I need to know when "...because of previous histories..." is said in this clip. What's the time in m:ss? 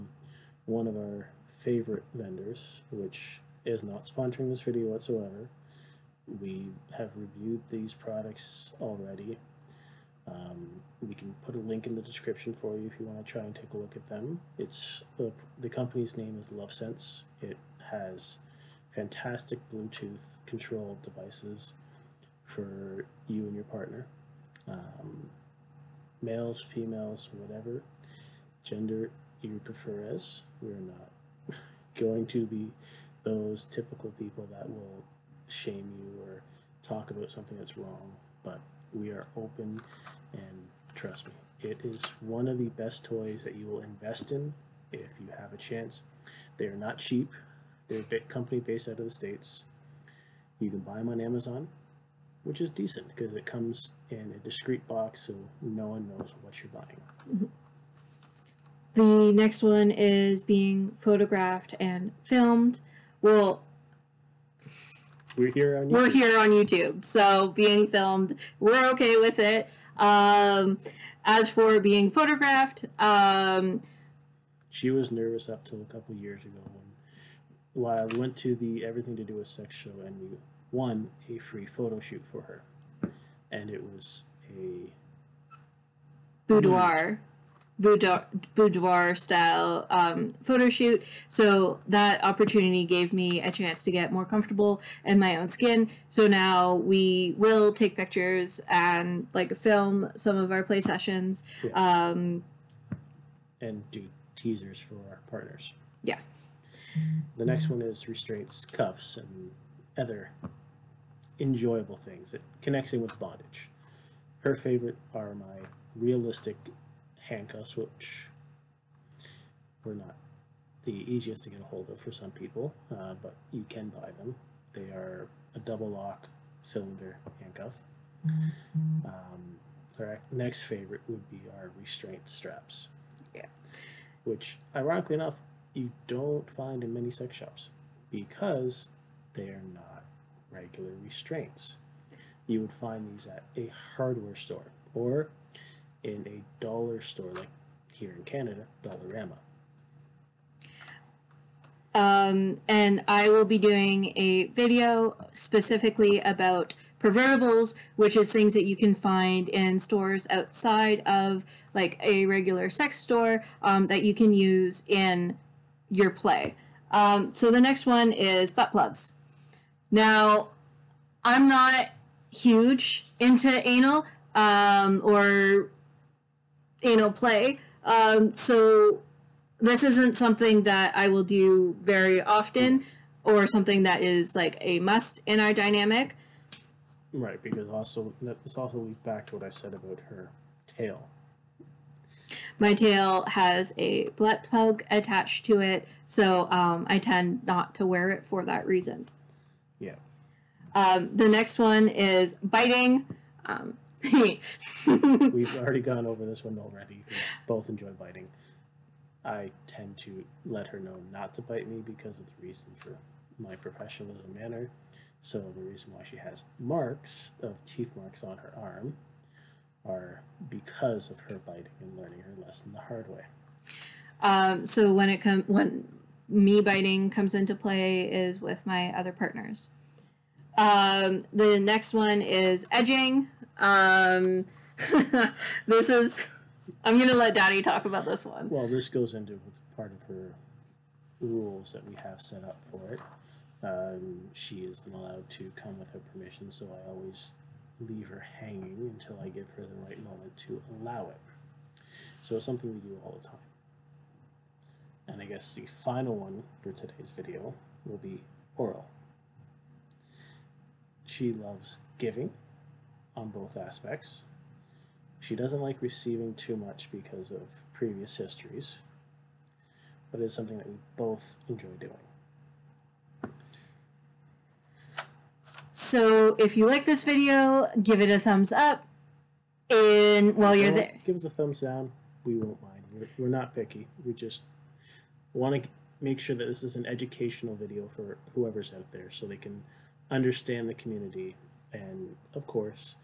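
4:26.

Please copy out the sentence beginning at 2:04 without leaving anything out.
They are a double lock cylinder handcuff.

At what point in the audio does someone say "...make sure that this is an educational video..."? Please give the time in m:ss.
4:46.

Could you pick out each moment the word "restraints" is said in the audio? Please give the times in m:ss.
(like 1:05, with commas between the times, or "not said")
1:48, 2:11, 2:21.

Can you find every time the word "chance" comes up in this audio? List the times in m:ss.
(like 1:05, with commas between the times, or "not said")
0:45, 1:33.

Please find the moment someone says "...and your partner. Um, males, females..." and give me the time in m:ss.
0:23.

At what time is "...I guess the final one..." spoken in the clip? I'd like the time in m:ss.
4:15.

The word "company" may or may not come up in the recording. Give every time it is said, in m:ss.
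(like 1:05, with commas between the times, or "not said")
0:15, 0:48.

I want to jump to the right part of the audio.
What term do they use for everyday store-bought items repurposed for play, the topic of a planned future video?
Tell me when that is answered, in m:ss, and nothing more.
2:36.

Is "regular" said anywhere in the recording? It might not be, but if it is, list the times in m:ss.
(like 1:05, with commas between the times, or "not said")
2:20, 2:42.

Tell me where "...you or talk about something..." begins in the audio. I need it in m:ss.
0:35.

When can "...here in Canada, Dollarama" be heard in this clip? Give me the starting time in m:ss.
2:27.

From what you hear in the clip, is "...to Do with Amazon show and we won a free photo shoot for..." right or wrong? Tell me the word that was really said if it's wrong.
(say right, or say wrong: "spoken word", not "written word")
wrong: "Sex", not "Amazon".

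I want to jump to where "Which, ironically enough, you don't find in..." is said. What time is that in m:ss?
2:14.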